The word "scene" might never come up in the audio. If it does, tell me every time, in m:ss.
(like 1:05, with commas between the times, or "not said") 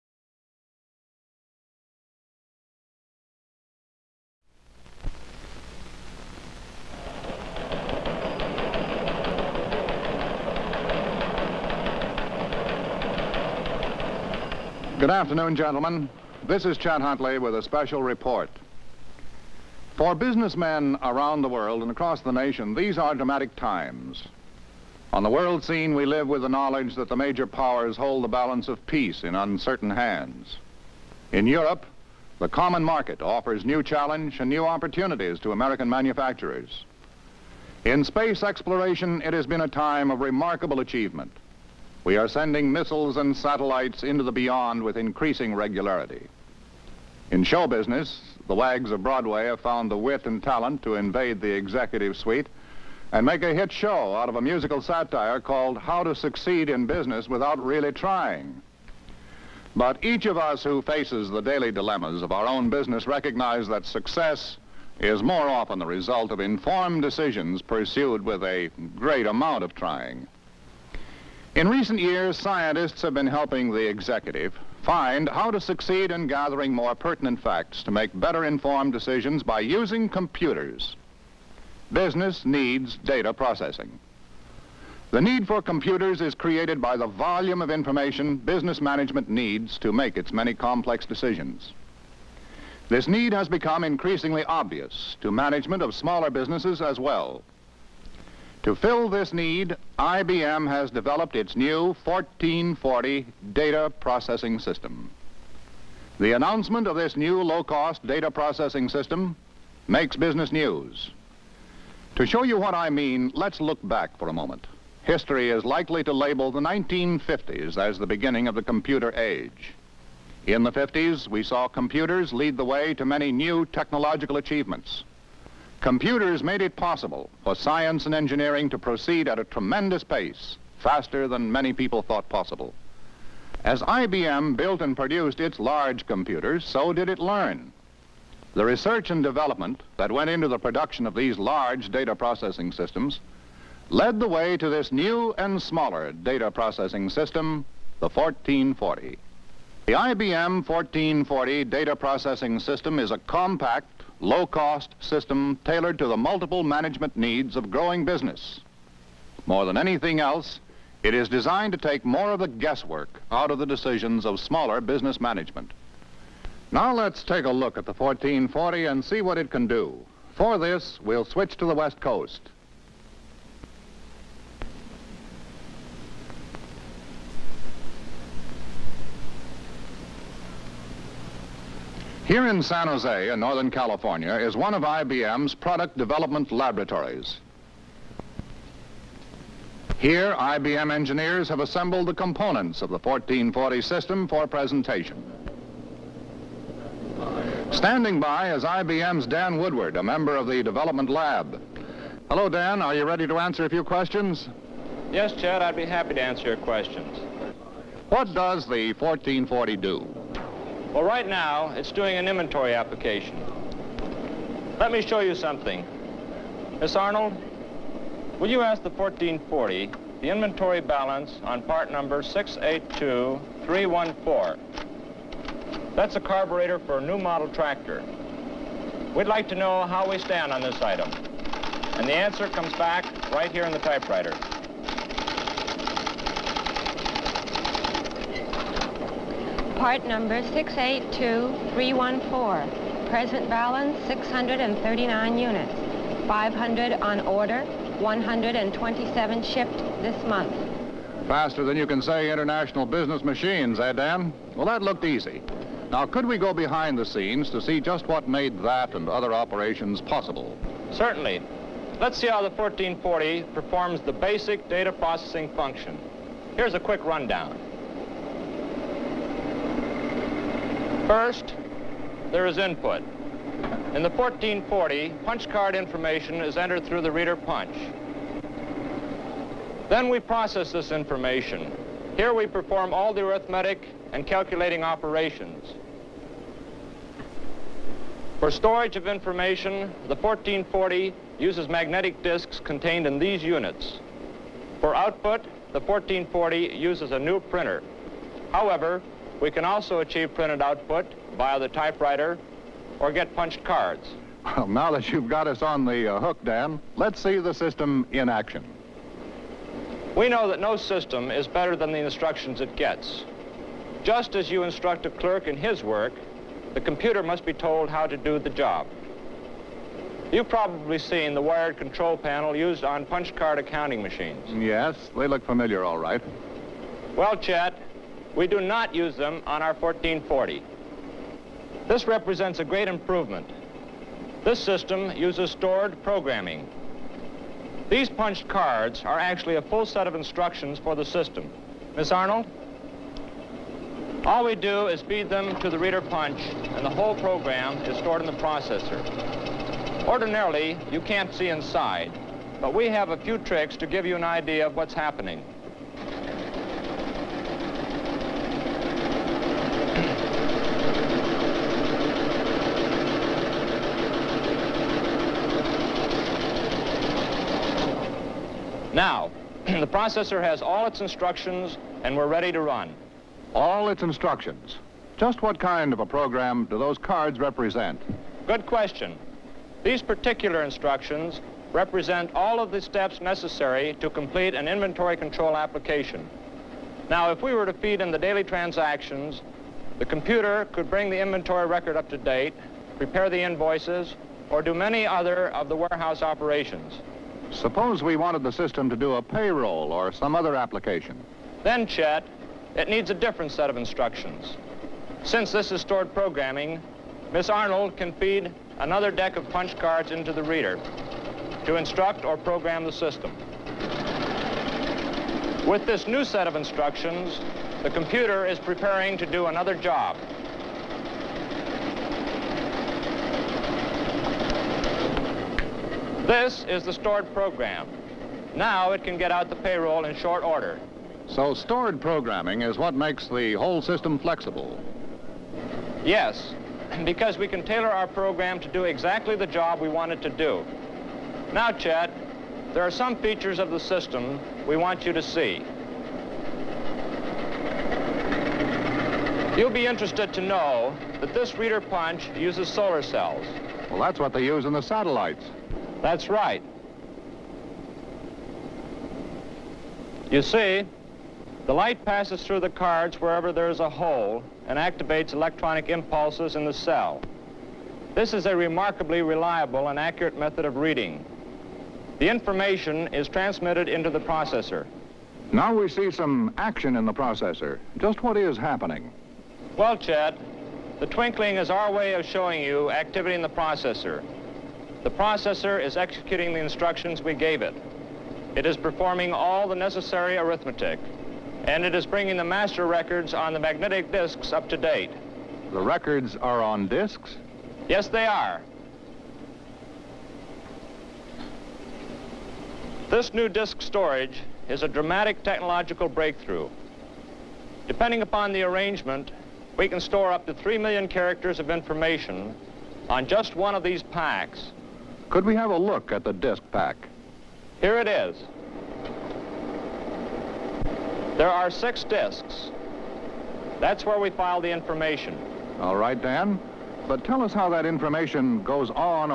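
0:25, 4:17.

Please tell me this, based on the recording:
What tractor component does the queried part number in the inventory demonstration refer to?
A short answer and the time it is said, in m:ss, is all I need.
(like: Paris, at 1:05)
carburetor, at 3:46.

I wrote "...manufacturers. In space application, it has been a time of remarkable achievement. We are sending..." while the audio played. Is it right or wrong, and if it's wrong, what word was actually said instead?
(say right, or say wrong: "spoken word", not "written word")
wrong: "exploration", not "application".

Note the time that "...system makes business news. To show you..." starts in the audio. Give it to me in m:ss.
1:48.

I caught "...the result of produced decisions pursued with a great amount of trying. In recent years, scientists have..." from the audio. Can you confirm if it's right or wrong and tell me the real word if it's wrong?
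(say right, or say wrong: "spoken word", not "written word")
wrong: "informed", not "produced".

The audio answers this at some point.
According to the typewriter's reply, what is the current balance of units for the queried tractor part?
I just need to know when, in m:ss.
4:04.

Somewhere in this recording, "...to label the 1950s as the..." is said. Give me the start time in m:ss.
1:56.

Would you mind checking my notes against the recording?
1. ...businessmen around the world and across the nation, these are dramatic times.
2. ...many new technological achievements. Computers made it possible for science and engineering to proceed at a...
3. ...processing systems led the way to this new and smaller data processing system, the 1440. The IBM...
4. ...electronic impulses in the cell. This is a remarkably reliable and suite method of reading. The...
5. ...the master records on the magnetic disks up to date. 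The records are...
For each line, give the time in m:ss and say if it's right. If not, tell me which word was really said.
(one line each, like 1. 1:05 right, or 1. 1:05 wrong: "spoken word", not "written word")
1. 0:20 right
2. 2:03 right
3. 2:22 right
4. 7:45 wrong: "accurate", not "suite"
5. 8:12 right.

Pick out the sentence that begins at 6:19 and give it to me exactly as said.
These particular instructions represent all of the steps necessary to complete an inventory control application.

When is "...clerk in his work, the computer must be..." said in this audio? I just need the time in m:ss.
5:15.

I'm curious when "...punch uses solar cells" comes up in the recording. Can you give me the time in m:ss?
7:31.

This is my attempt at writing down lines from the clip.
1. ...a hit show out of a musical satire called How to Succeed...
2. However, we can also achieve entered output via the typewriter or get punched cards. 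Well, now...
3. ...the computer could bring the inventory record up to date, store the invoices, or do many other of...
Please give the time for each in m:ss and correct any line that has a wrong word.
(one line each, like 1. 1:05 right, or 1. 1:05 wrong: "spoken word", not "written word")
1. 0:53 right
2. 4:58 wrong: "printed", not "entered"
3. 6:29 wrong: "prepare", not "store".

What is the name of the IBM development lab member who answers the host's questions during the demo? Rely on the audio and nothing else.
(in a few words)
Dan Woodward.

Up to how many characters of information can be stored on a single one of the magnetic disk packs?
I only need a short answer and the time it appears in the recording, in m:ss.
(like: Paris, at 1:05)
3 million, at 8:30.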